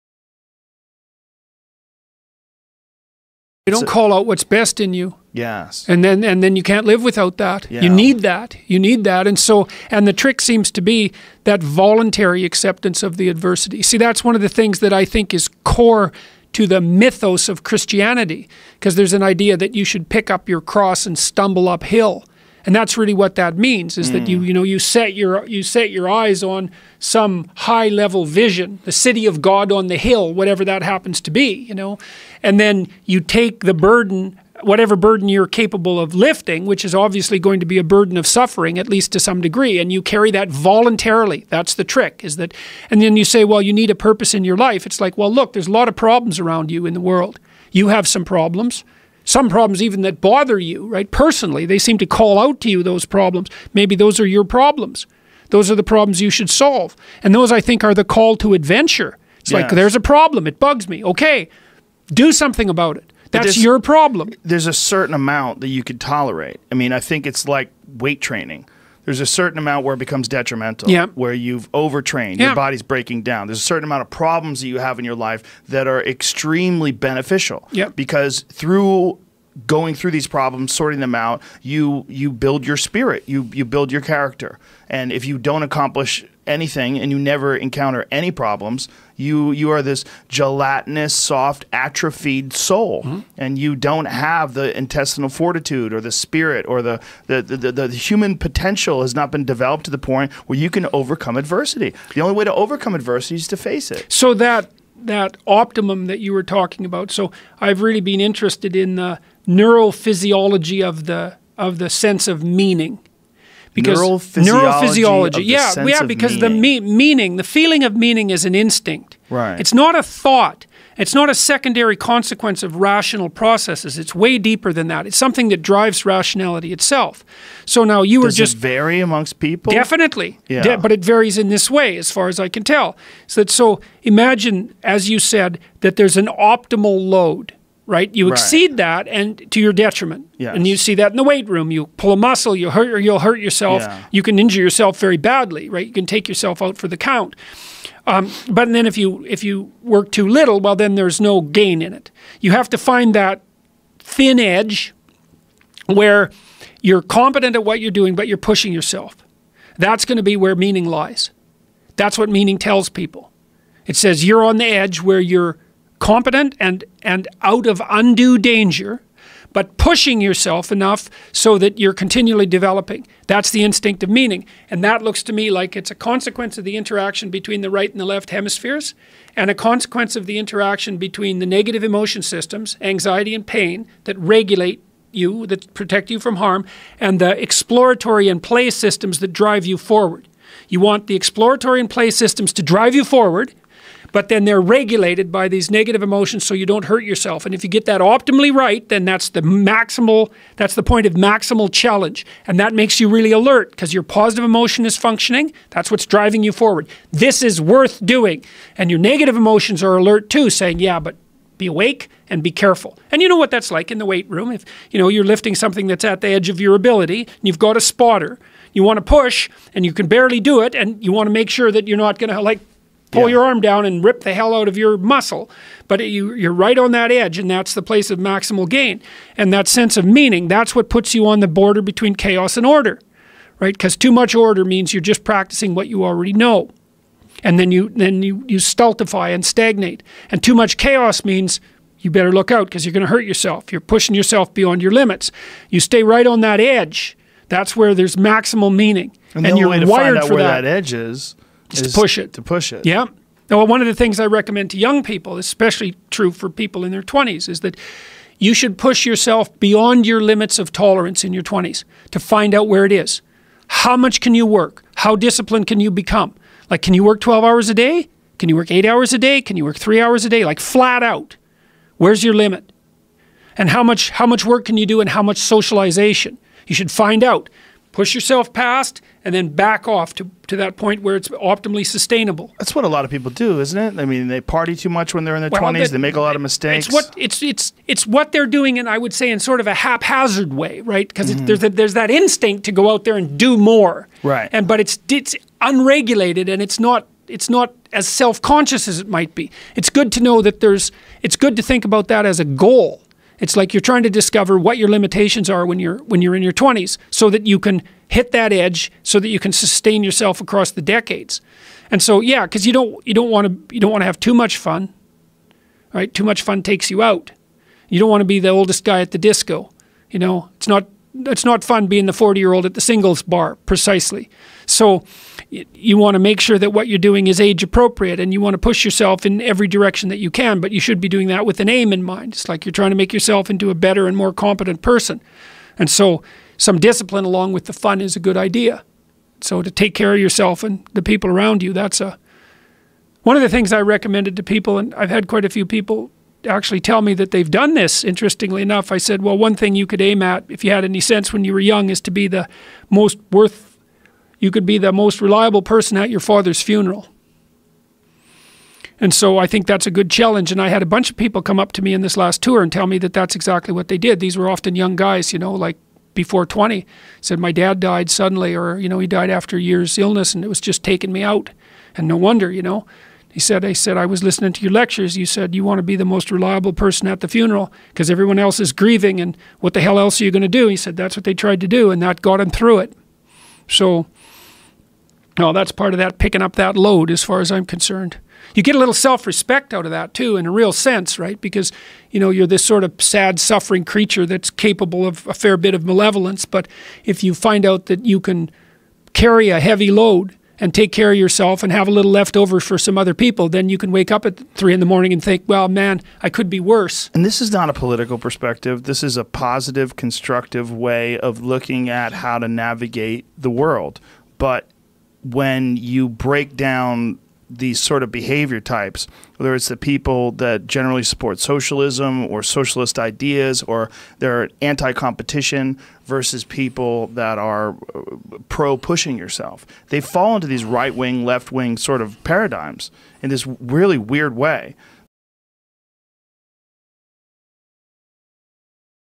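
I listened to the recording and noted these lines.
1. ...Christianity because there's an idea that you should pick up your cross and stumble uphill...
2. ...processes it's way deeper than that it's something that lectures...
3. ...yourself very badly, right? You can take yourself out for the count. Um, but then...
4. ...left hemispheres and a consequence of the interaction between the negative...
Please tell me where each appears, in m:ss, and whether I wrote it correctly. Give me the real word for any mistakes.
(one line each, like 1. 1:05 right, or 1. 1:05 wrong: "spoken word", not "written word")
1. 0:17 right
2. 2:03 wrong: "drives", not "lectures"
3. 2:24 right
4. 2:58 right.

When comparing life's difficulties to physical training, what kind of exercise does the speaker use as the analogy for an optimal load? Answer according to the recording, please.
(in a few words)
weight training.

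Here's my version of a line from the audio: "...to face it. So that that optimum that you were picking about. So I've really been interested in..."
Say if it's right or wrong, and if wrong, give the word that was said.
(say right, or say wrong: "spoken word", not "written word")
wrong: "talking", not "picking".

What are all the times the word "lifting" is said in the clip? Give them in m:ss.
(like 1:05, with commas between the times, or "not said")
0:36, 3:35.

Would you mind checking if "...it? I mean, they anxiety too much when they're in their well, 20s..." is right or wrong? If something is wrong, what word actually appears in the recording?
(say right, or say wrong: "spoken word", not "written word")
wrong: "party", not "anxiety".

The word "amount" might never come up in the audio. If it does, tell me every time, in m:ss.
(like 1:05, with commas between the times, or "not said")
1:05, 1:09, 1:13.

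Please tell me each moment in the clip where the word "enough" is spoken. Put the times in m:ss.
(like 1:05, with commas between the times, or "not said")
2:50, 5:48.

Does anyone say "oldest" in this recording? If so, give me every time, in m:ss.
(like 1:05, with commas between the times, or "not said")
5:18.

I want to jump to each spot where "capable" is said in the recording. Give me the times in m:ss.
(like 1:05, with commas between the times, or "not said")
0:35, 6:34.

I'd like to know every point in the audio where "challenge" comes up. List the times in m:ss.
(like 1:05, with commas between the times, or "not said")
3:21, 6:00.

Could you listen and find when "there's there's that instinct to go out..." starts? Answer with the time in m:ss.
4:51.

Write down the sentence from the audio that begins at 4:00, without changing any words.
And too much chaos means you better look out because you're going to hurt yourself.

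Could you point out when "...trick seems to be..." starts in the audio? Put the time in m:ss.
0:10.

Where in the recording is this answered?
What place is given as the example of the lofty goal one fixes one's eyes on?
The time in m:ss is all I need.
0:28.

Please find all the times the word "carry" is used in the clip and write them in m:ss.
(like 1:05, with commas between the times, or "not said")
0:40, 6:39.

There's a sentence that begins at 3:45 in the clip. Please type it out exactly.
But you, you're right on that edge, and that's the place of maximal gain.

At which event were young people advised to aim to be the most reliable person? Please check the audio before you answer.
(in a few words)
your father's funeral.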